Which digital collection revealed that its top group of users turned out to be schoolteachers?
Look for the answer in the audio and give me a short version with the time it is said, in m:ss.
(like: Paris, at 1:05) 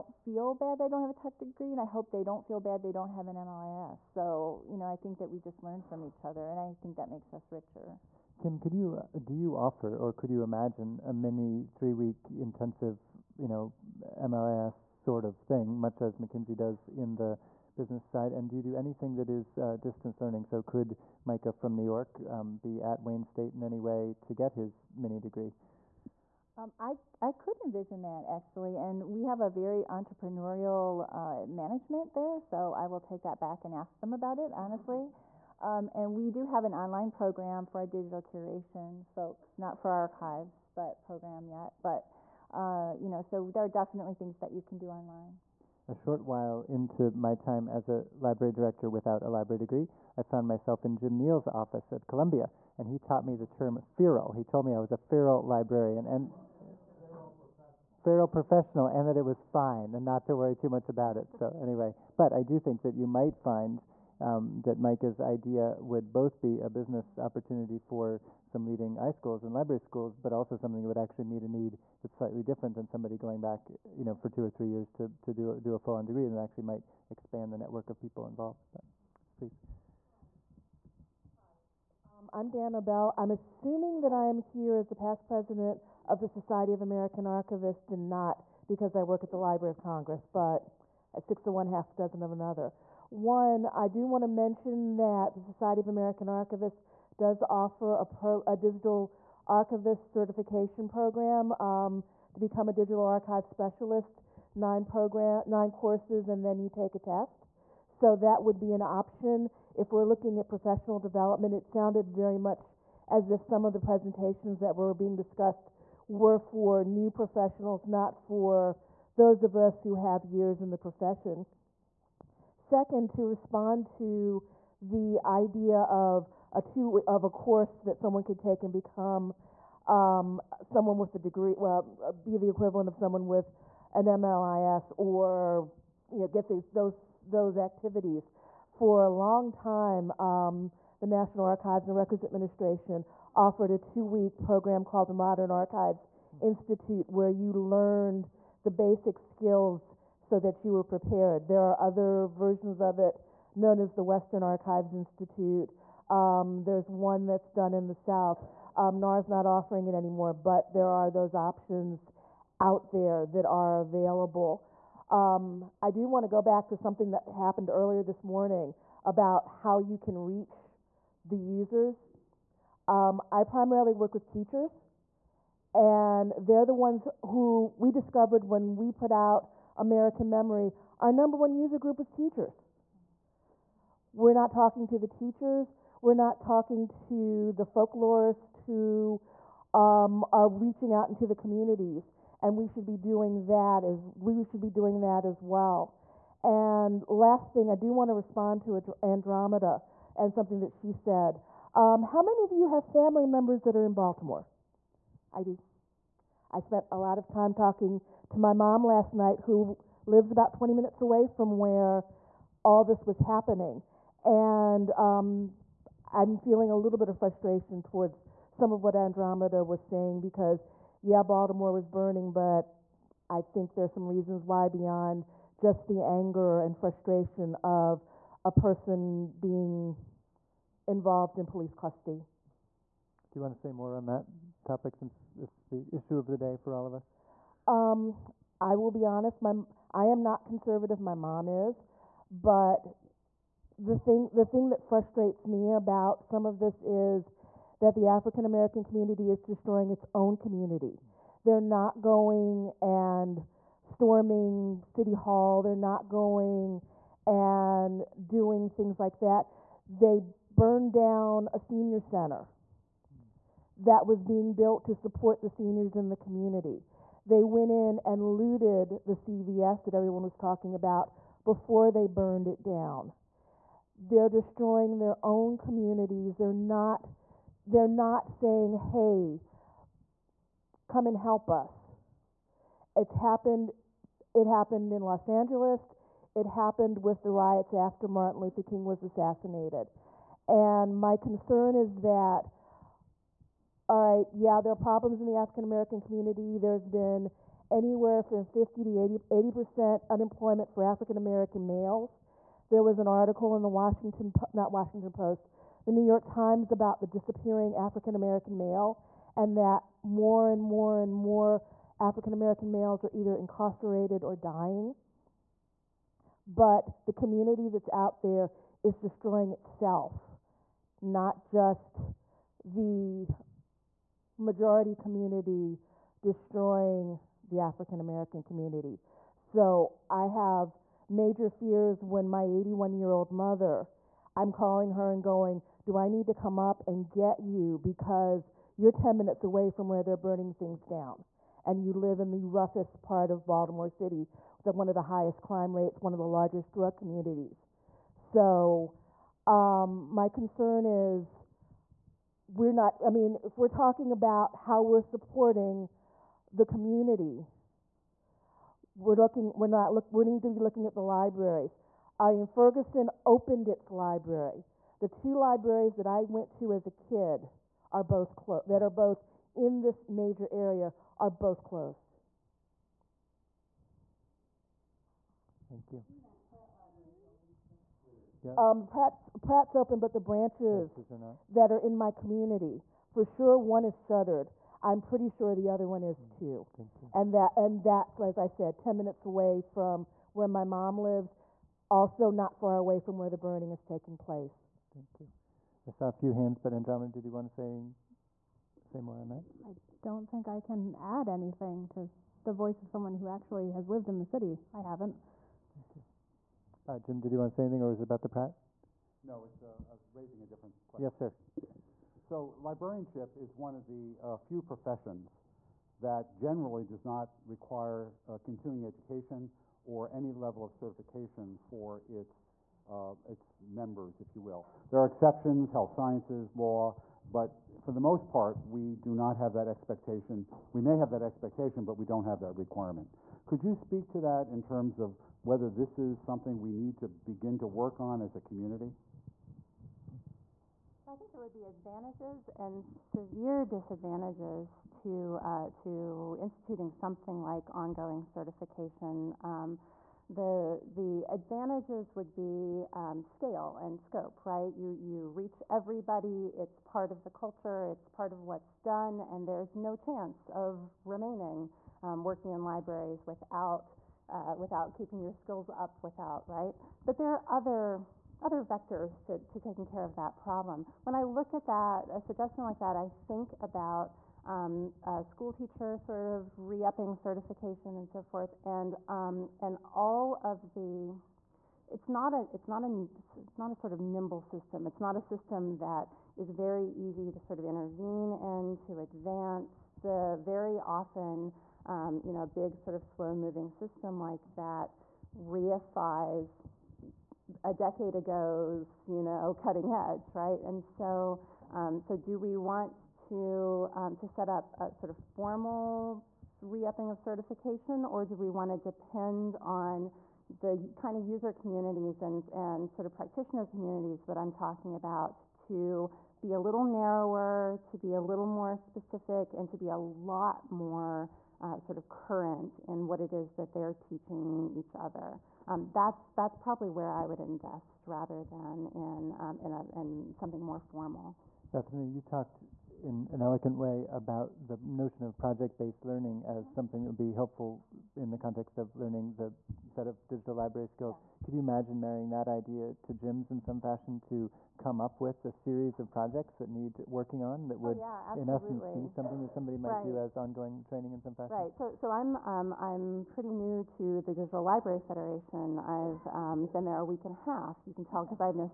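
American Memory, at 2:59.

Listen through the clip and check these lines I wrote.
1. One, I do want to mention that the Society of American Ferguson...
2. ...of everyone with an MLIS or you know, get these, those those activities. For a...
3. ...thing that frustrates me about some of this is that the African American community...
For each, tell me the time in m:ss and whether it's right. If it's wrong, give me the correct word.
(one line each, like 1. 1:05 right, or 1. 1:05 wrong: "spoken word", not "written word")
1. 1:33 wrong: "Archivists", not "Ferguson"
2. 2:12 wrong: "someone", not "everyone"
3. 4:04 right.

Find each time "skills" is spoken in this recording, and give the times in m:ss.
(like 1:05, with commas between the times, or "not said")
2:29, 7:45, 9:00.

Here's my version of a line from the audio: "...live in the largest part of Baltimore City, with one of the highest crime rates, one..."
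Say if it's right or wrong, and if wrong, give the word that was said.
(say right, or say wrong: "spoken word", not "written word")
wrong: "roughest", not "largest".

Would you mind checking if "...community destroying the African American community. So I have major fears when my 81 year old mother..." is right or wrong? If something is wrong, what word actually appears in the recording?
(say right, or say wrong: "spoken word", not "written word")
right.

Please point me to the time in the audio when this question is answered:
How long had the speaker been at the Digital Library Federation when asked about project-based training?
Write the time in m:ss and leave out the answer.
9:16.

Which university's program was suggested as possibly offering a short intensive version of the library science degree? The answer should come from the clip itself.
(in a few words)
Wayne State.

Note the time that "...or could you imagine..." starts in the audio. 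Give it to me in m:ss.
0:09.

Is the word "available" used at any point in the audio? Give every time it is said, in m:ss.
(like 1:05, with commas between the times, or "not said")
2:43.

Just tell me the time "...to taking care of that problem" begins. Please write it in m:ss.
7:49.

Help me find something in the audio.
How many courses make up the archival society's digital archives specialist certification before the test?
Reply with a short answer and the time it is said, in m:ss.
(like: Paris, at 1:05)
9, at 1:45.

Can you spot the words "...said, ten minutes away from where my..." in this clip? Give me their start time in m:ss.
6:28.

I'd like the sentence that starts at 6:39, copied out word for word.
I don't think I can add anything to the voice of someone who actually has lived in the city.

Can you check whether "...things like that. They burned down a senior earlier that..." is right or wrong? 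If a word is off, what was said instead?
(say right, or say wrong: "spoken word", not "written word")
wrong: "center", not "earlier".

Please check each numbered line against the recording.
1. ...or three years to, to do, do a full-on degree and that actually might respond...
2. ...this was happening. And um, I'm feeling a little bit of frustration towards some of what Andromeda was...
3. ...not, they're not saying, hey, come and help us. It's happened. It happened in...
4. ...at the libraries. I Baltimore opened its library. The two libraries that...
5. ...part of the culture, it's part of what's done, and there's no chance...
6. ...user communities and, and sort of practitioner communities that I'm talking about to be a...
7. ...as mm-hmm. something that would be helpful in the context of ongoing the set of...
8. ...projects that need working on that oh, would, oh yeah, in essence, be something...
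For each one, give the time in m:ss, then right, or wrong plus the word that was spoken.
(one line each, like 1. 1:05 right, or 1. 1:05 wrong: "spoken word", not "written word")
1. 1:14 wrong: "expand", not "respond"
2. 3:32 right
3. 4:36 right
4. 6:00 wrong: "Ferguson", not "Baltimore"
5. 7:36 right
6. 8:31 right
7. 8:56 wrong: "learning", not "ongoing"
8. 9:06 right.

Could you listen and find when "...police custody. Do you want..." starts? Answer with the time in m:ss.
3:51.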